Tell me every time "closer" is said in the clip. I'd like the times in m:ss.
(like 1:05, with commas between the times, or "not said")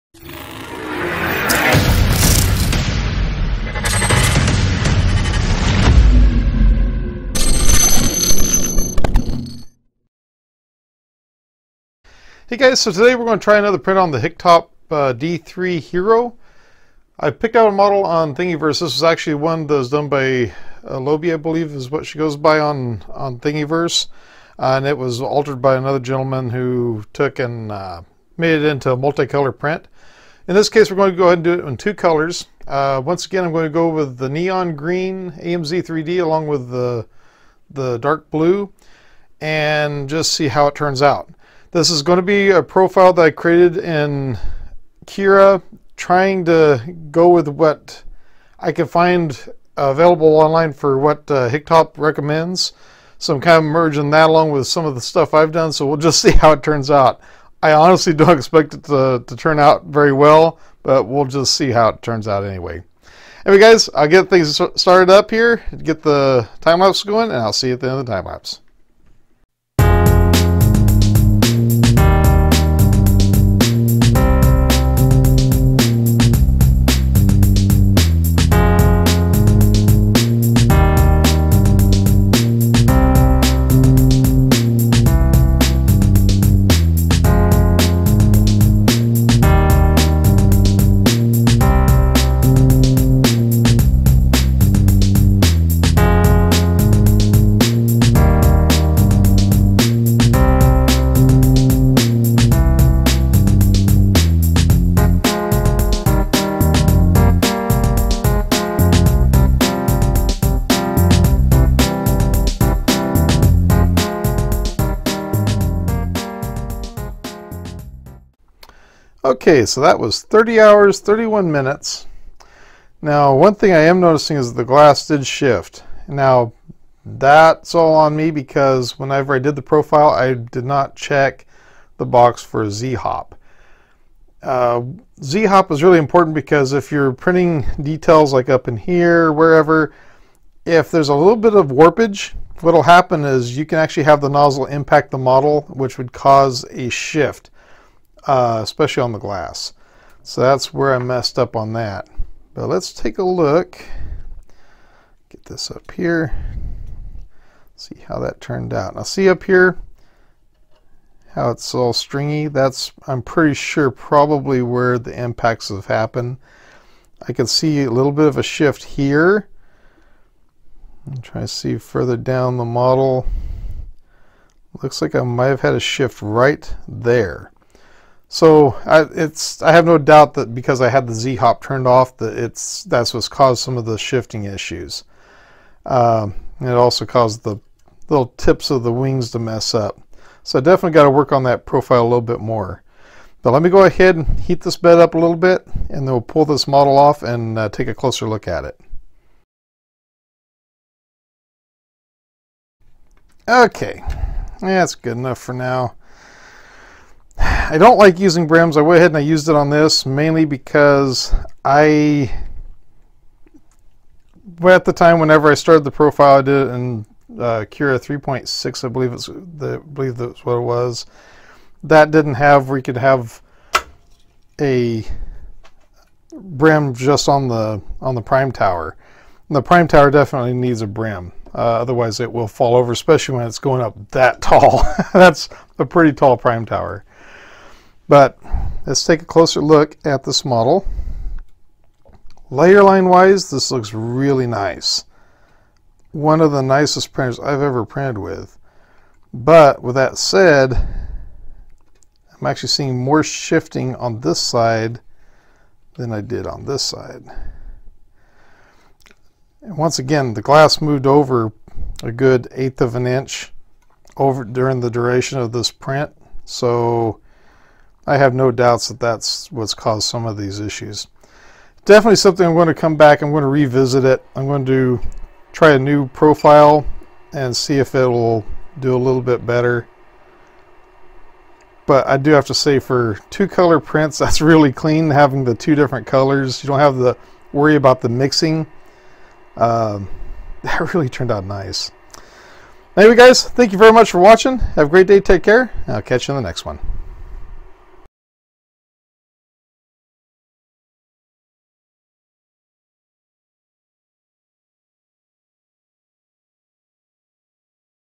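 3:17, 3:59.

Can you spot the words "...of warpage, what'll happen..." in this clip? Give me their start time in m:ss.
2:21.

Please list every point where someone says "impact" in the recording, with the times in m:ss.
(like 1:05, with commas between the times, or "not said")
2:24, 2:45.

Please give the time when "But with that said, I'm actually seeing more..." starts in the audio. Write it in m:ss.
4:09.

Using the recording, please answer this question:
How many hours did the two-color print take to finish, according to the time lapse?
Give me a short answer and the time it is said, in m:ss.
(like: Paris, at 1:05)
30 hours, at 2:00.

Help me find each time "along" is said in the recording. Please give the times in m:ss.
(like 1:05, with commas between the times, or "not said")
0:36, 0:54.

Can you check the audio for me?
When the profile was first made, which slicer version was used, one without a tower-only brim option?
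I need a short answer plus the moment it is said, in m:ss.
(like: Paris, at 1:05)
3.6, at 3:37.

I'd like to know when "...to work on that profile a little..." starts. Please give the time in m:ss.
3:11.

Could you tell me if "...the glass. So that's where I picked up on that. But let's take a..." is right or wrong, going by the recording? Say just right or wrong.
wrong.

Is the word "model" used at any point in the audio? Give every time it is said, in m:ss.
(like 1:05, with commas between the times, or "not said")
0:17, 2:25, 2:52, 3:16, 4:00.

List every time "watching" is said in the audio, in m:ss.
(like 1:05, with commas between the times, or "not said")
4:54.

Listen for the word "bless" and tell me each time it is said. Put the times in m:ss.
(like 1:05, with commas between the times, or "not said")
not said.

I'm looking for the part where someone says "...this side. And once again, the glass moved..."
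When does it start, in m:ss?
4:16.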